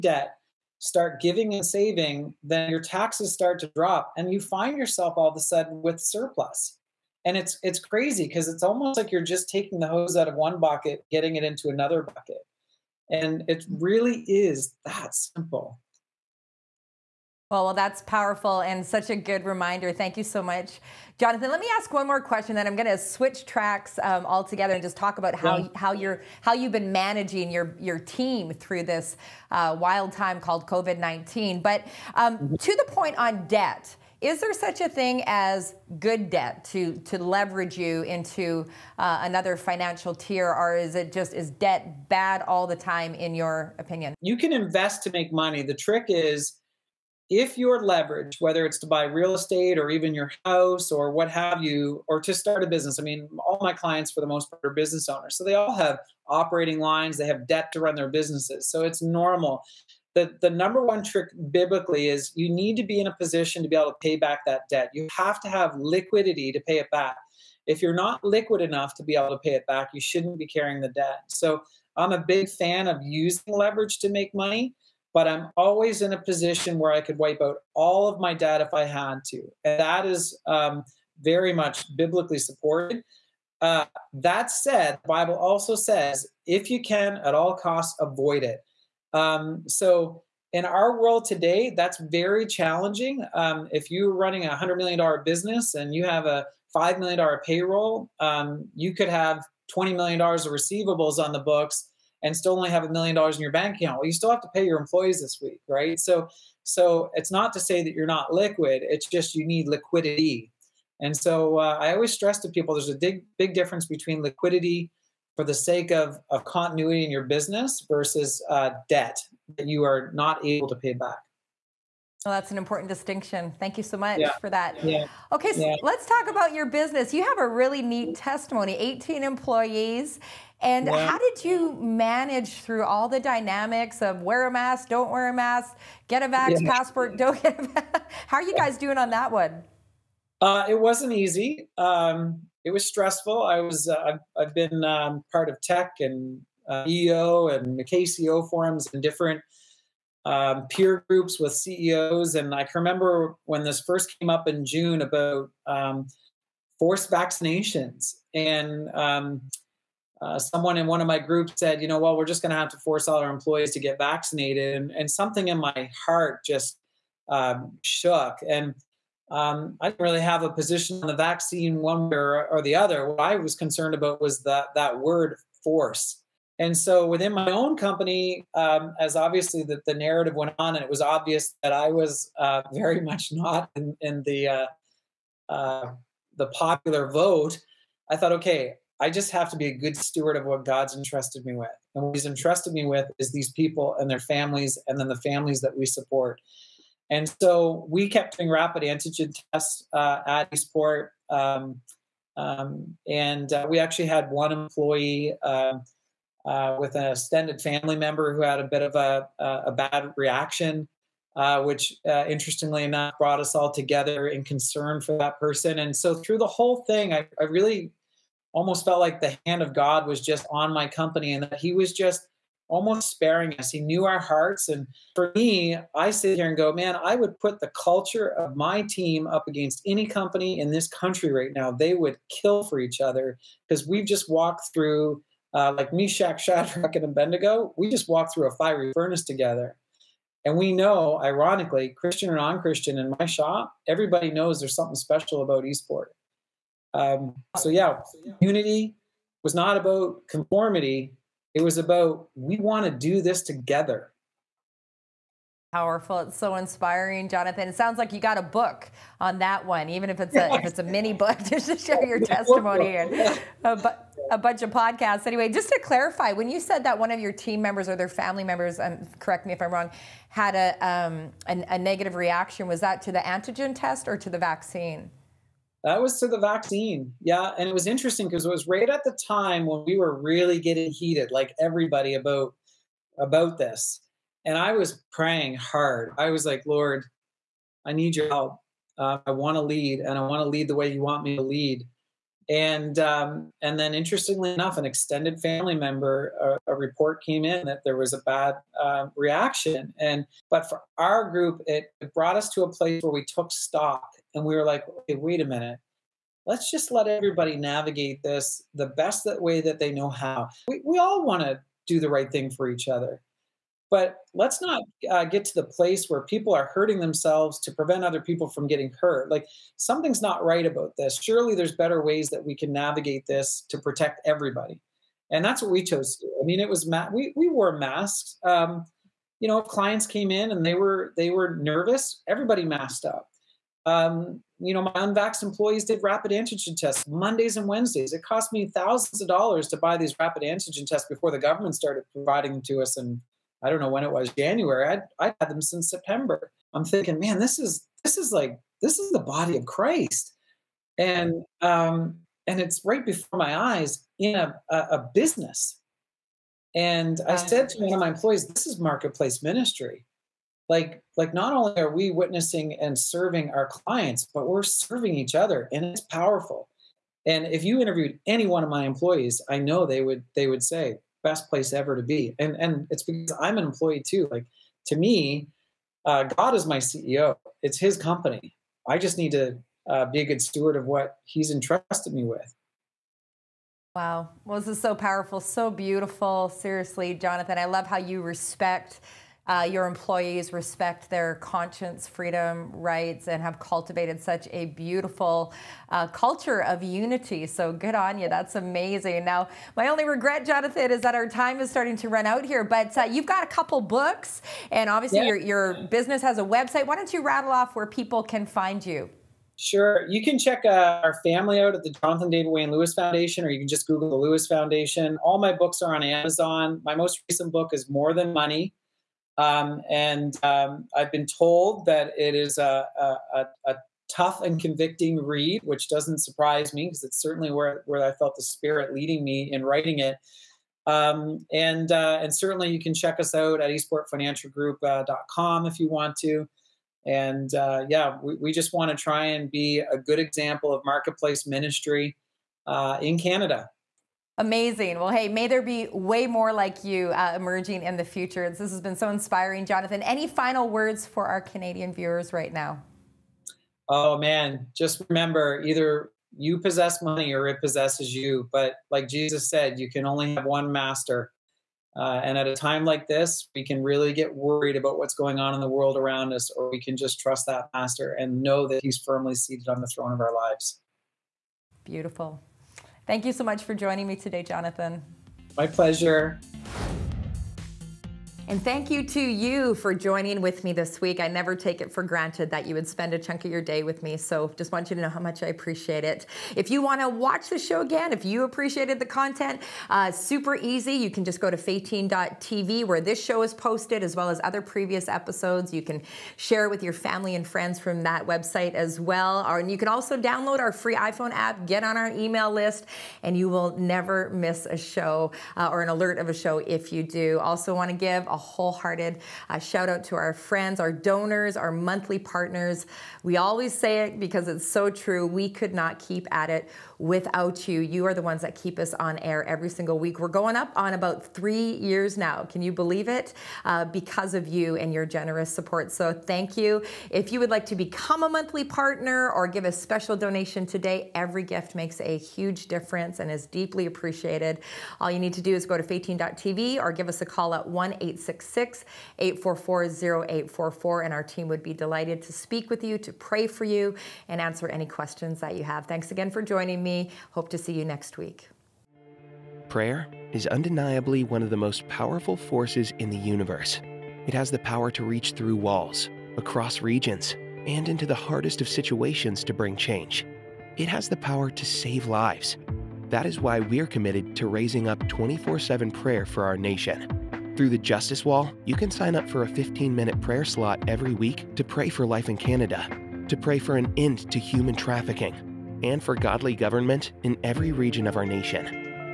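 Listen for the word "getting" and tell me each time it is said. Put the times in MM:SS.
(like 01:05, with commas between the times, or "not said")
00:11, 04:40, 05:18.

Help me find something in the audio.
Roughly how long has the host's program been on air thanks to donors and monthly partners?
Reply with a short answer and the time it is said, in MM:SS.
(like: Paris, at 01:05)
about 3 years, at 08:40.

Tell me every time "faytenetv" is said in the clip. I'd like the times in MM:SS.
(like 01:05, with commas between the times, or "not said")
08:11, 08:55.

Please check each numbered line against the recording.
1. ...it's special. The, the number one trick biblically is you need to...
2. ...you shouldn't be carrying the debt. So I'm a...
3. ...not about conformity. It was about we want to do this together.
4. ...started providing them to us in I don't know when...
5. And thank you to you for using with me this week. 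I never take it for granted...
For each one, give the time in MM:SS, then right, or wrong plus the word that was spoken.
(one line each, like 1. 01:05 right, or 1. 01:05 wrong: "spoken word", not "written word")
1. 00:58 wrong: "normal", not "special"
2. 01:09 right
3. 04:09 right
4. 05:41 right
5. 07:58 wrong: "joining", not "using".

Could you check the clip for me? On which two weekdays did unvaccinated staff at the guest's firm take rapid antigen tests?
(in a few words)
Mondays and Wednesdays.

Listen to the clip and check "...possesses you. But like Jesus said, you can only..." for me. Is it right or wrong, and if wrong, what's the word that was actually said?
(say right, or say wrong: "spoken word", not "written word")
right.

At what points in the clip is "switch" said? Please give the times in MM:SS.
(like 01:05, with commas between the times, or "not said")
00:22.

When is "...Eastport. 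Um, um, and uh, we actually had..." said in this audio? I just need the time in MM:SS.
03:20.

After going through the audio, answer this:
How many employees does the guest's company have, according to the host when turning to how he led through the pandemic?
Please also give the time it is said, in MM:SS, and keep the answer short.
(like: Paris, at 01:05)
18, at 02:08.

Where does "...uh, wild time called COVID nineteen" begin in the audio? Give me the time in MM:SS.
00:29.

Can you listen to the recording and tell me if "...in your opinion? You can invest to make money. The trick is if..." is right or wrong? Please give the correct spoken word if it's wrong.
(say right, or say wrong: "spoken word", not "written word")
right.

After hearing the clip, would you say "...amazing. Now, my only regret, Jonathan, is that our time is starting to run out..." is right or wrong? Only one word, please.
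right.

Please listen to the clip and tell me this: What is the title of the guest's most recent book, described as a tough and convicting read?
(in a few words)
More Than Money.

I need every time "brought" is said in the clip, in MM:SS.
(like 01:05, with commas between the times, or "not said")
03:33, 05:02.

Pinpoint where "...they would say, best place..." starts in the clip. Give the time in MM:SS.
06:10.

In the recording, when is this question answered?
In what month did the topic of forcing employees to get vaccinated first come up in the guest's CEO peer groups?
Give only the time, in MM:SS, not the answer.
02:34.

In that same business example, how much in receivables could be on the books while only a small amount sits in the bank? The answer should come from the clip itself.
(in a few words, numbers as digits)
$20 million.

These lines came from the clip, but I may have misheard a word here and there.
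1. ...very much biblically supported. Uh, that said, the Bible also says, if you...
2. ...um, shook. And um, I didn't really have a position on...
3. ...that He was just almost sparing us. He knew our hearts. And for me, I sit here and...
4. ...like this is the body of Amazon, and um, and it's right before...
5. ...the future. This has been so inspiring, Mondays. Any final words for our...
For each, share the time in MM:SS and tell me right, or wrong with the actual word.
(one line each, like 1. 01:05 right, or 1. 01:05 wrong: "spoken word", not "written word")
1. 01:21 right
2. 02:47 right
3. 03:41 right
4. 05:48 wrong: "Christ", not "Amazon"
5. 07:27 wrong: "Jonathan", not "Mondays".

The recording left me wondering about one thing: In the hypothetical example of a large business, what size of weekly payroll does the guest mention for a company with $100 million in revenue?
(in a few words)
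$5 million.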